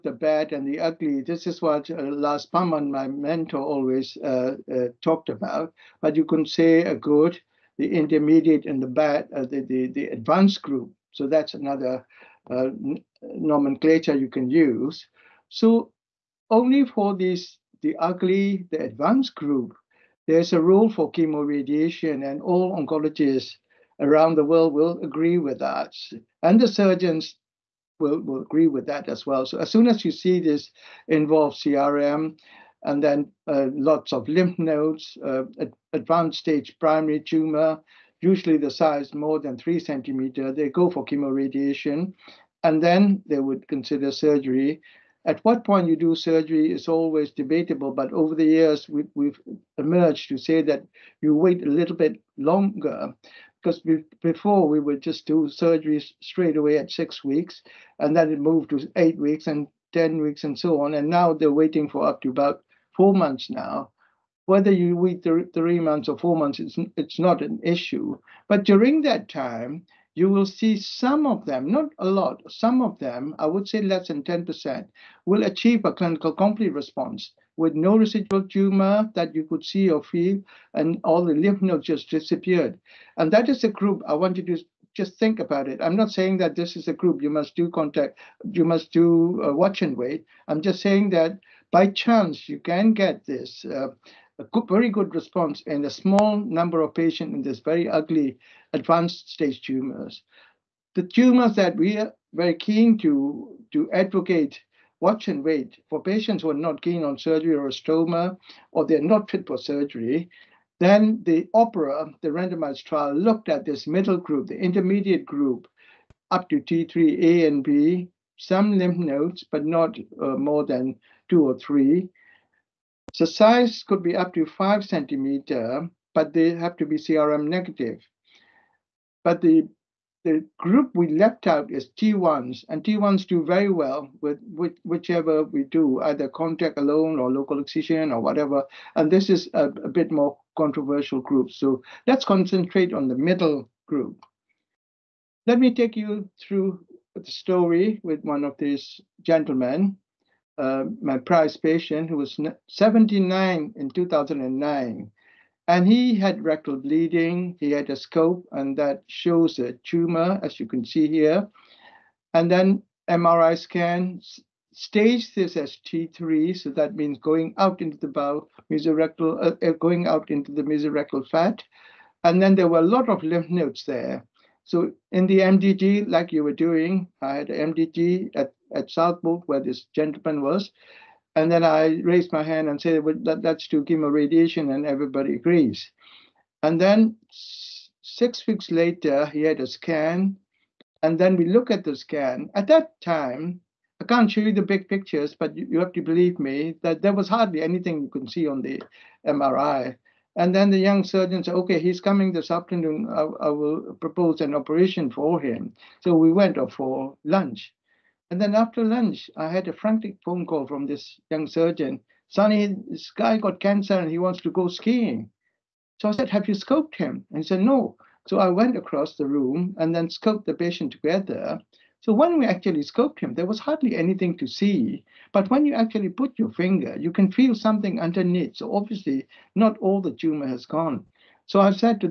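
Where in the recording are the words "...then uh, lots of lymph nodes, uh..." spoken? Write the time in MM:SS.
00:33.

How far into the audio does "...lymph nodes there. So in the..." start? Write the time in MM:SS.
02:53.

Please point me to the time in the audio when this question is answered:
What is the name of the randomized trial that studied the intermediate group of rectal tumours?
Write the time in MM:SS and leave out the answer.
01:51.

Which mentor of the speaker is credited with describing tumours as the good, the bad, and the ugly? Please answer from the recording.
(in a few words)
Lars Påhlman.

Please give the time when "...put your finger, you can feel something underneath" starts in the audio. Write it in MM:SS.
03:46.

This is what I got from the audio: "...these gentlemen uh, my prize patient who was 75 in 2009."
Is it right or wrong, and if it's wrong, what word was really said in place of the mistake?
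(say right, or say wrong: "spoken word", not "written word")
wrong: "79", not "75".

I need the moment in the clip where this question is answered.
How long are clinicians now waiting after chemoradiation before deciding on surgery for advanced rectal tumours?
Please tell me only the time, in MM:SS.
01:02.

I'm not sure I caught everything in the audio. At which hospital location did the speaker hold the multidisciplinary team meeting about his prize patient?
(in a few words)
Southport.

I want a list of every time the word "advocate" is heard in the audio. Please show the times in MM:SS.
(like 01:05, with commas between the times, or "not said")
01:43.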